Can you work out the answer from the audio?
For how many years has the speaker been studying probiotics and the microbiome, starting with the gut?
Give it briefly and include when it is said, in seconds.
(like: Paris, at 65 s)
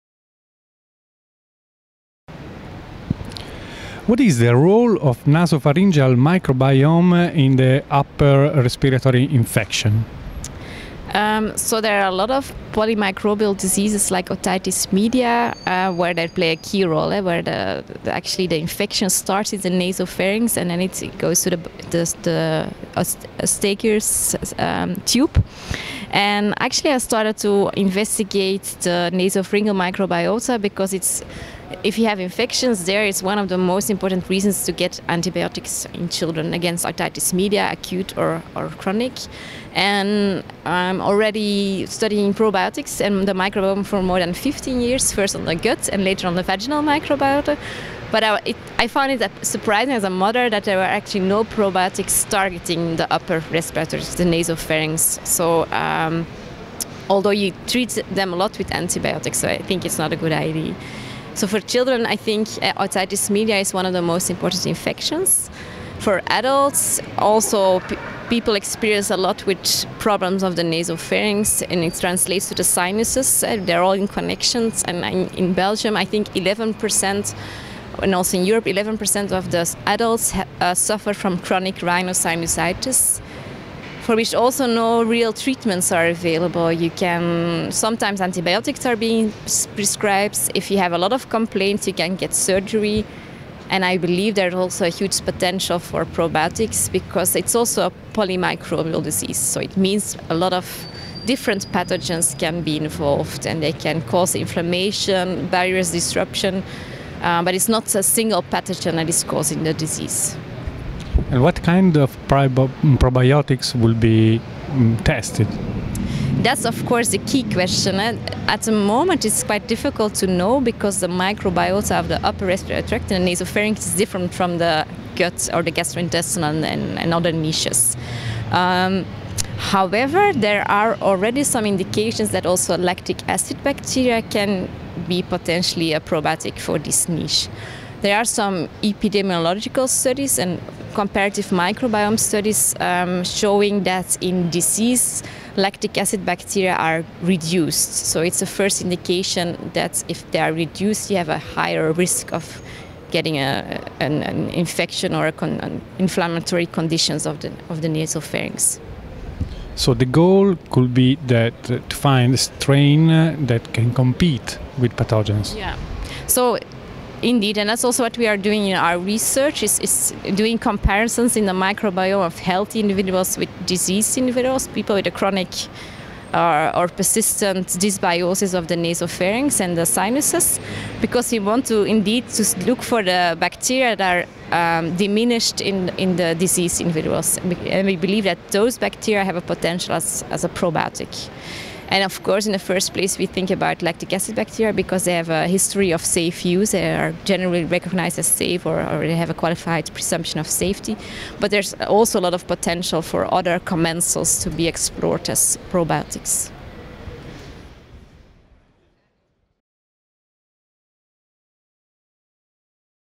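more than 15 years, at 44 s.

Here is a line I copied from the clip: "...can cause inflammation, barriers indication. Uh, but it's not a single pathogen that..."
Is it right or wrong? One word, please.
wrong.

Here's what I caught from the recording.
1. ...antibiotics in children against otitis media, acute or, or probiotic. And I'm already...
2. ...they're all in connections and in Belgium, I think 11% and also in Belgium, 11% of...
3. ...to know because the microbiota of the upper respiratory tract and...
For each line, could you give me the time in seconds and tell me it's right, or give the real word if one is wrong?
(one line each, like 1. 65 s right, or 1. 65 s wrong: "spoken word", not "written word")
1. 35 s wrong: "chronic", not "probiotic"
2. 73 s wrong: "Europe", not "Belgium"
3. 120 s right.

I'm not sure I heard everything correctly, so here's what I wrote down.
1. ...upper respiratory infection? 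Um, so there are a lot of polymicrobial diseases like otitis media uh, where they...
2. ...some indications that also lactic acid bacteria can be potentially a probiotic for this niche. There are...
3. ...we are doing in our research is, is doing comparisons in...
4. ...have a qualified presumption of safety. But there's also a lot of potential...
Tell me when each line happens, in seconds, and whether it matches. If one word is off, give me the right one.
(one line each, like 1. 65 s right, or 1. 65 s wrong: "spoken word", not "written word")
1. 7 s right
2. 131 s right
3. 168 s right
4. 199 s right.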